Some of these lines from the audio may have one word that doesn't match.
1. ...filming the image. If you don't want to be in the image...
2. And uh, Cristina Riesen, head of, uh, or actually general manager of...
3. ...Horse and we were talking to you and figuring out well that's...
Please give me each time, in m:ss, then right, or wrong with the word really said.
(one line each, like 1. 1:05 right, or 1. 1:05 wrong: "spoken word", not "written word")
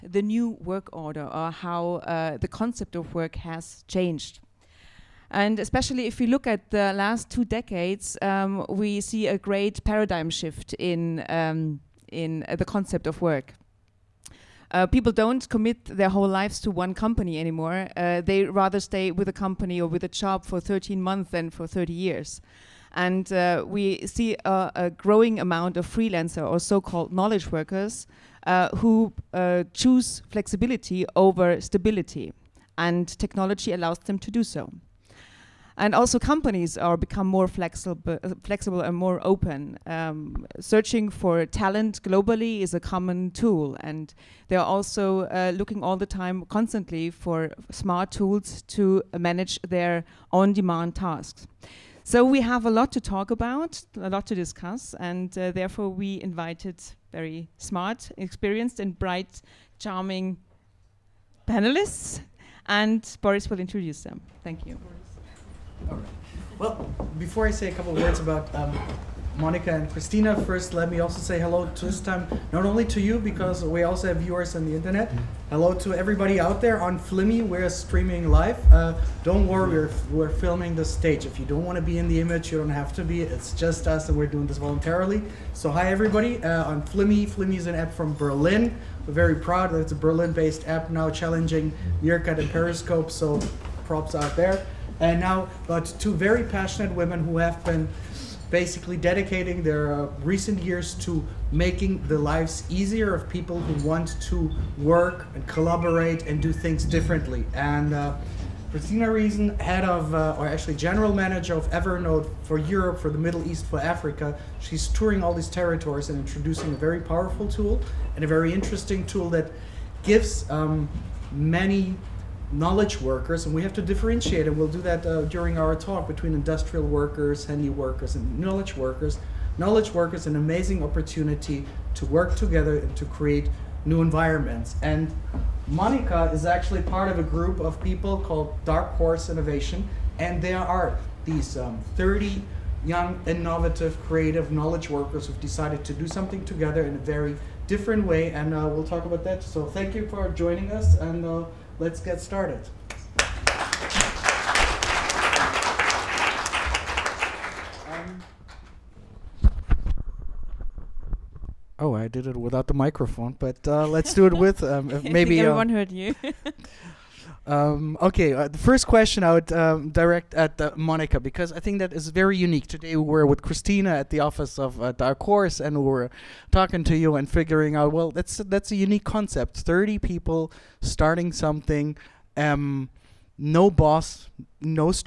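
1. 1:20 wrong: "stage", not "image"
2. 1:47 right
3. 2:55 right.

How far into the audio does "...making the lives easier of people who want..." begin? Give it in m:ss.
1:41.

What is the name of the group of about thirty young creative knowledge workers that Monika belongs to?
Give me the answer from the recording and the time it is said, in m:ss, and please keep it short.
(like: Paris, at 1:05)
Dark Horse Innovation, at 2:18.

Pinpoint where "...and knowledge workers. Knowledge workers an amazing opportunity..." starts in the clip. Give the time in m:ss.
2:08.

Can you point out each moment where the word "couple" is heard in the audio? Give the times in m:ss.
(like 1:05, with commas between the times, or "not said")
1:07.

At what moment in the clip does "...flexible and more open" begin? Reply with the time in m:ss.
0:38.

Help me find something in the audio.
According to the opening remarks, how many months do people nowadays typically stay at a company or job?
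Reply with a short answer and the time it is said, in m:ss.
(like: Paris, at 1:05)
13, at 0:20.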